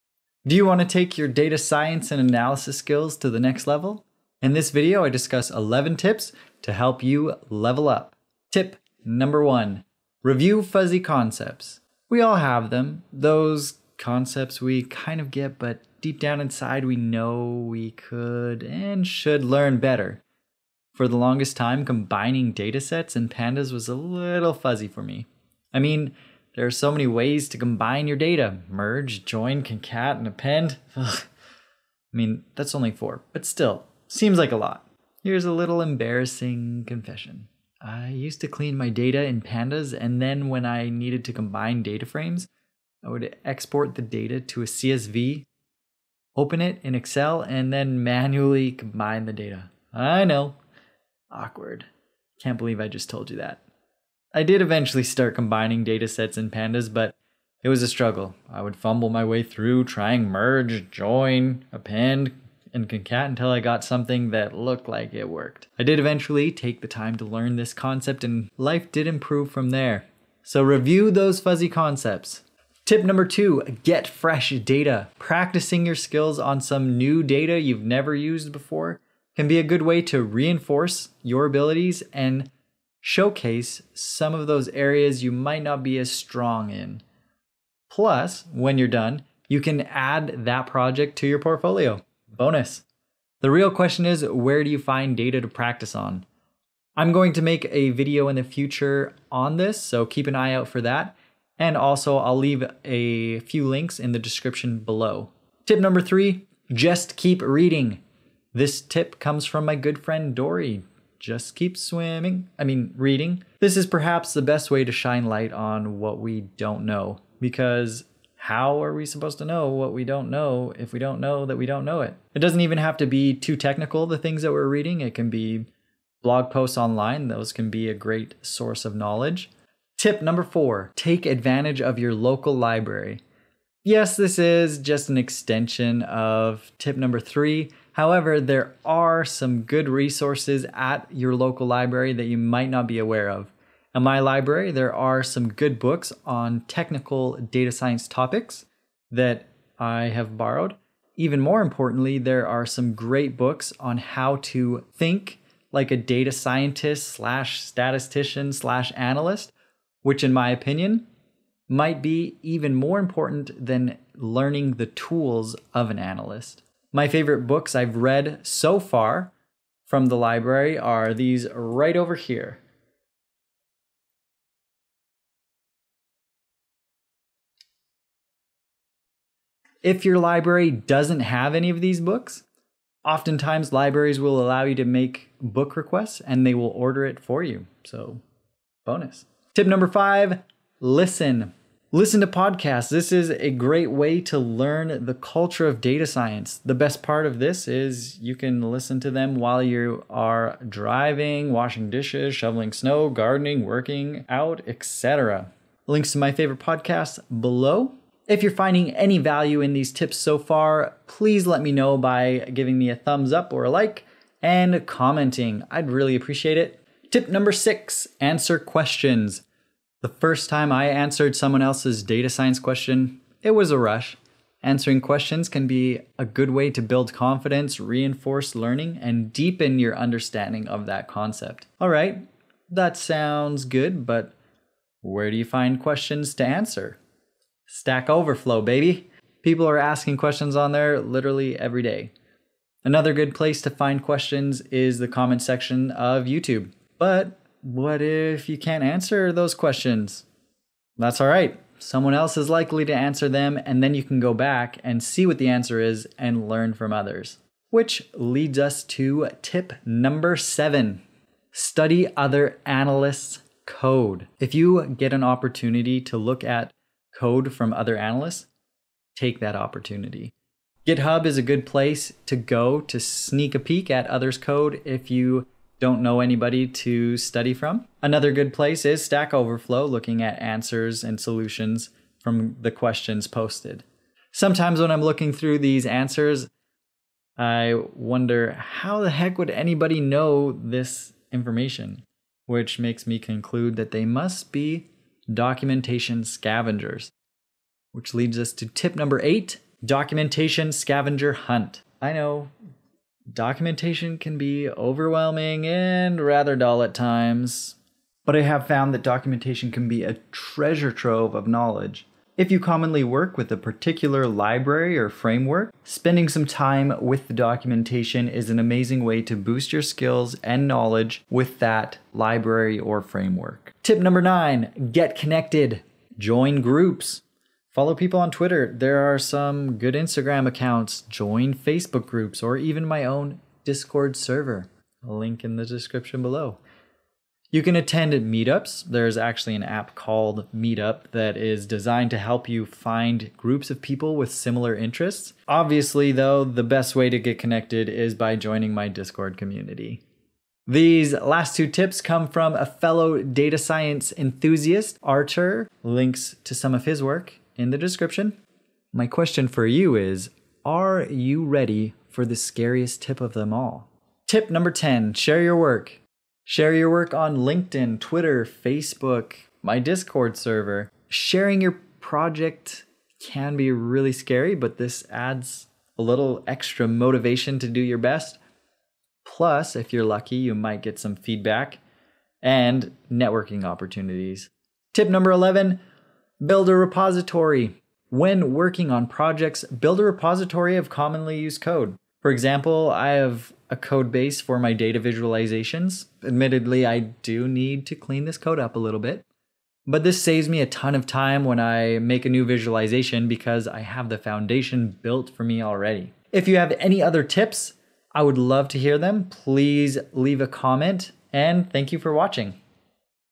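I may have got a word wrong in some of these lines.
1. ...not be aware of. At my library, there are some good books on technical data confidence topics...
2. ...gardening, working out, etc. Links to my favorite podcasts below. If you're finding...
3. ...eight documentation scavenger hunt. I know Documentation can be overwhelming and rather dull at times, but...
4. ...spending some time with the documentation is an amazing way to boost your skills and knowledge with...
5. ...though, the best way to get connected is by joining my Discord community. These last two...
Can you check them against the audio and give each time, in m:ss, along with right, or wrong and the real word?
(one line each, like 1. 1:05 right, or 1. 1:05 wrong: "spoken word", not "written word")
1. 2:22 wrong: "science", not "confidence"
2. 3:23 right
3. 4:59 right
4. 5:15 right
5. 5:46 right.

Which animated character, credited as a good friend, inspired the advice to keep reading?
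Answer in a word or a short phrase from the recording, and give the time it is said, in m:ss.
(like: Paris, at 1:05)
Dory, at 1:50.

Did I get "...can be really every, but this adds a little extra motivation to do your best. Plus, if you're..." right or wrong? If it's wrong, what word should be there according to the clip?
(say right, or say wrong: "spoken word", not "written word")
wrong: "scary", not "every".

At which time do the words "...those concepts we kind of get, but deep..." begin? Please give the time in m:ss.
0:13.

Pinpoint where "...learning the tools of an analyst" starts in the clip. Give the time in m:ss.
2:44.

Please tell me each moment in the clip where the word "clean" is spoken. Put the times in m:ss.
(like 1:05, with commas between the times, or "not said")
0:38, 6:37.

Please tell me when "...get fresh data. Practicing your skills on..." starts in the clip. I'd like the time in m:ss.
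1:13.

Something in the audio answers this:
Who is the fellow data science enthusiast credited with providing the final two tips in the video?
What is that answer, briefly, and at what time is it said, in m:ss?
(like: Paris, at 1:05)
Archer, at 5:55.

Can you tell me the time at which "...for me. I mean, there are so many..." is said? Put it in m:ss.
0:24.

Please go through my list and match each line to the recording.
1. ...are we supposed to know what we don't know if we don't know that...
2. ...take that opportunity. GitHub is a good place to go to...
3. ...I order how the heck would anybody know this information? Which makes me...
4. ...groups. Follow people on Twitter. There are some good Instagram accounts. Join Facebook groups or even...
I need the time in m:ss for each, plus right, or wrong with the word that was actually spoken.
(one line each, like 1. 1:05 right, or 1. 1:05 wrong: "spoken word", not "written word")
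1. 1:58 right
2. 4:29 right
3. 4:47 wrong: "wonder", not "order"
4. 5:26 right.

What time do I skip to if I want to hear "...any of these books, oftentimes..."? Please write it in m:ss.
3:01.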